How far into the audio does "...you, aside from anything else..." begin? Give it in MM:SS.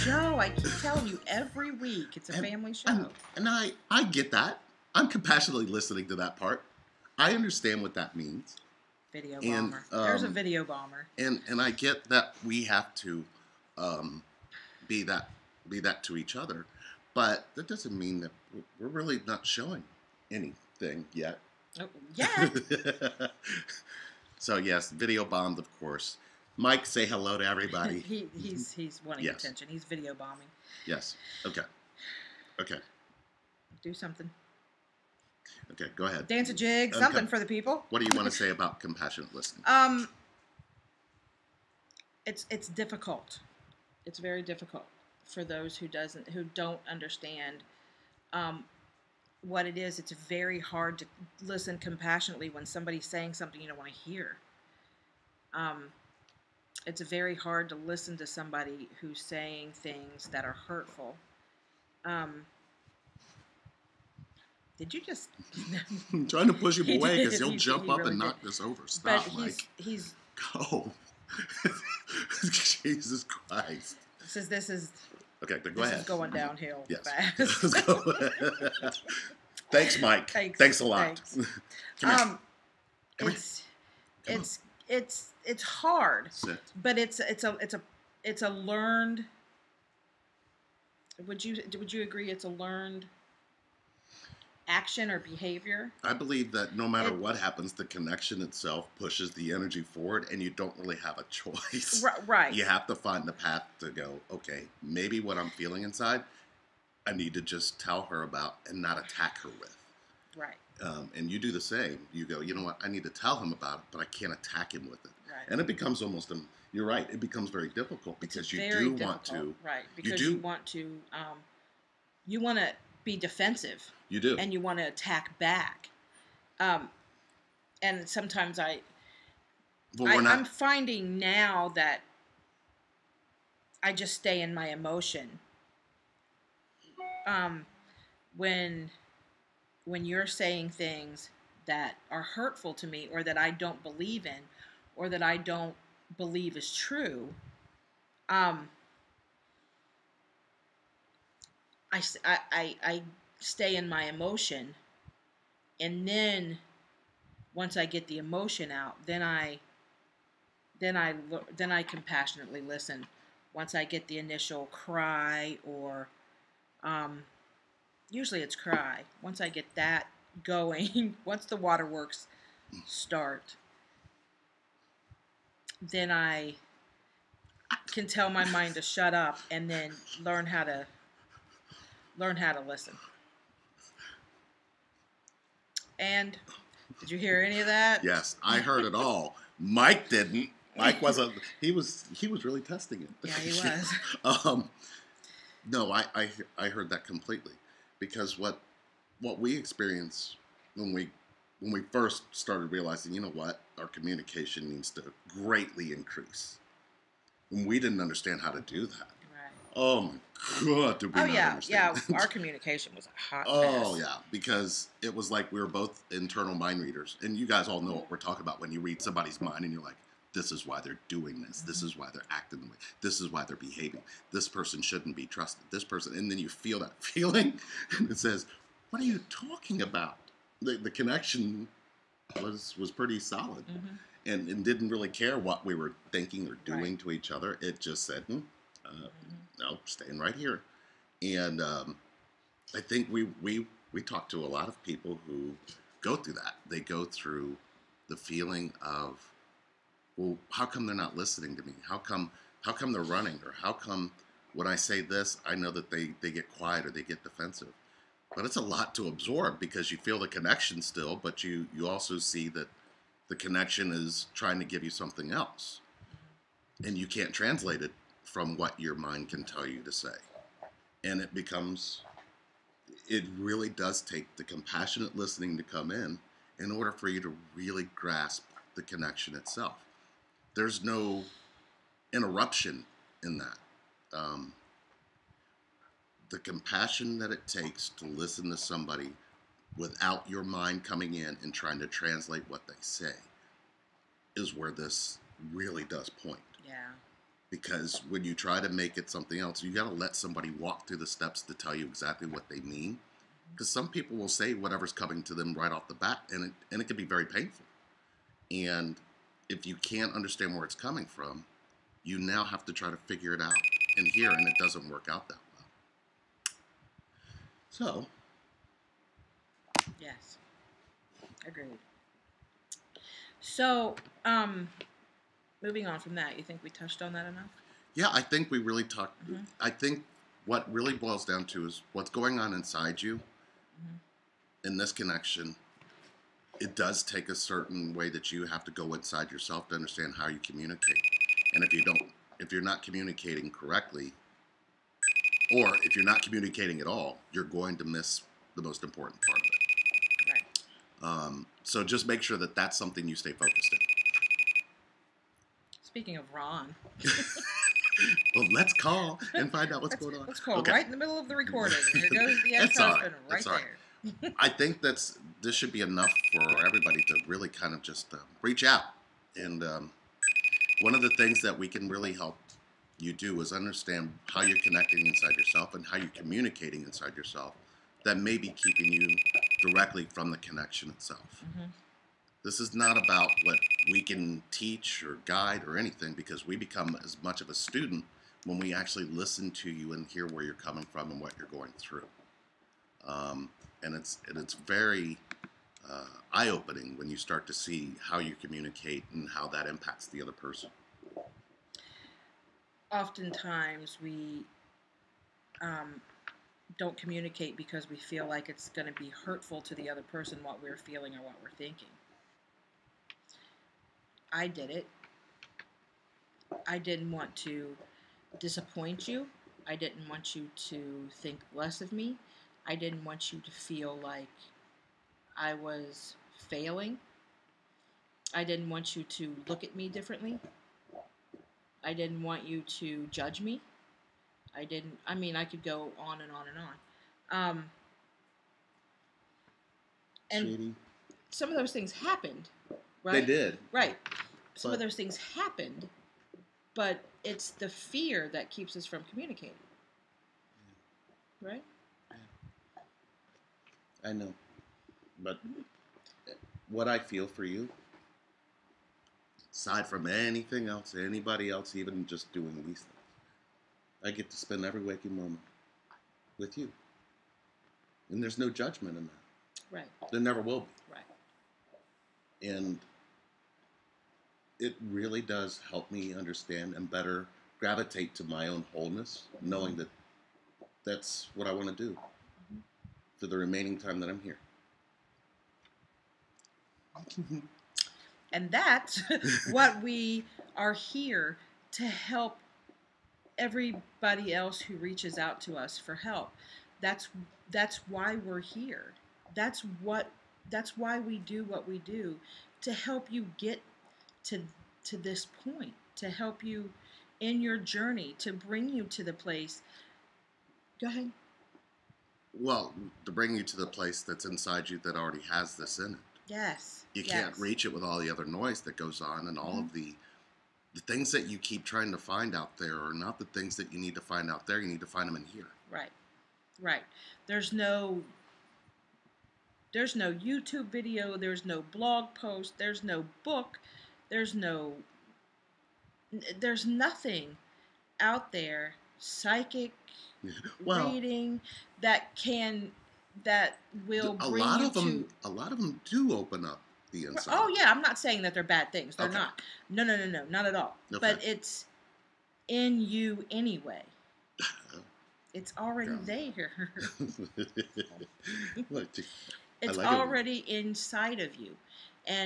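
07:37.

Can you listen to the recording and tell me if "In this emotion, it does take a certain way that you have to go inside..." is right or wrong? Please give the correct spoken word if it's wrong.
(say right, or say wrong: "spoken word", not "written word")
wrong: "connection", not "emotion".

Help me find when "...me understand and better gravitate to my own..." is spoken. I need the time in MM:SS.
07:55.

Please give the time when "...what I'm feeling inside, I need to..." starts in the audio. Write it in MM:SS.
01:45.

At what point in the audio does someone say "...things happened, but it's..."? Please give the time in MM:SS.
07:24.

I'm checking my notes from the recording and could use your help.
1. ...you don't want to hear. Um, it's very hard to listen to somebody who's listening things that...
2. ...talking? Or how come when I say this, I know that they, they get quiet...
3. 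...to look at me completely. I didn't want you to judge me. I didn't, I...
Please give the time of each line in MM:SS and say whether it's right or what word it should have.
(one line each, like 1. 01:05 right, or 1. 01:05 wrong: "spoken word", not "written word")
1. 00:53 wrong: "saying", not "listening"
2. 04:13 wrong: "running", not "talking"
3. 07:09 wrong: "differently", not "completely".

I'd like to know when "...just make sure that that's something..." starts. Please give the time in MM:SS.
05:51.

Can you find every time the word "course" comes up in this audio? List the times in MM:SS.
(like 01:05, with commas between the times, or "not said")
00:25.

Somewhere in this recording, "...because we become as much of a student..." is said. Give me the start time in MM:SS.
06:26.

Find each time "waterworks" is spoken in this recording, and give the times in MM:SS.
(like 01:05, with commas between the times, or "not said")
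02:51.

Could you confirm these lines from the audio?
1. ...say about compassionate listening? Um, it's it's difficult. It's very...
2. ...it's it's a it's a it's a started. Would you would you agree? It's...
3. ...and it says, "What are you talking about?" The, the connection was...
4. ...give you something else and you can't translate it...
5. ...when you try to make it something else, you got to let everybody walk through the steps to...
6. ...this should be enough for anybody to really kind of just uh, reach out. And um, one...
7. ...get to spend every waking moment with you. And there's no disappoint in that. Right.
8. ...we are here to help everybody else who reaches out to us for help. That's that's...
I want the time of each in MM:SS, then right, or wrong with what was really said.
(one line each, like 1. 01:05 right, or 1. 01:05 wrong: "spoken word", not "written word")
1. 00:38 right
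2. 01:26 wrong: "learned", not "started"
3. 03:47 right
4. 04:24 right
5. 04:58 wrong: "somebody", not "everybody"
6. 06:05 wrong: "everybody", not "anybody"
7. 07:44 wrong: "judgment", not "disappoint"
8. 08:09 right.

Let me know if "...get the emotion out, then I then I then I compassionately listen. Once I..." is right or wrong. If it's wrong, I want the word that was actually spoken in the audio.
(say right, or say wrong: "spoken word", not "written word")
right.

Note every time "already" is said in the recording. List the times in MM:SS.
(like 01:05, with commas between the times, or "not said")
08:34, 09:15, 09:19.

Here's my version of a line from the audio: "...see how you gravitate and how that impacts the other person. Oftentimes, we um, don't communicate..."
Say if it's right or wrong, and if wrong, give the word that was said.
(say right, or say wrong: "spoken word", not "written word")
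wrong: "communicate", not "gravitate".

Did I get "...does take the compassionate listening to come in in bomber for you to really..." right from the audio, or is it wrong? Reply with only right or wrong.
wrong.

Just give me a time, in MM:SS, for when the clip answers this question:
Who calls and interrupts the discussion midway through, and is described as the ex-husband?
05:55.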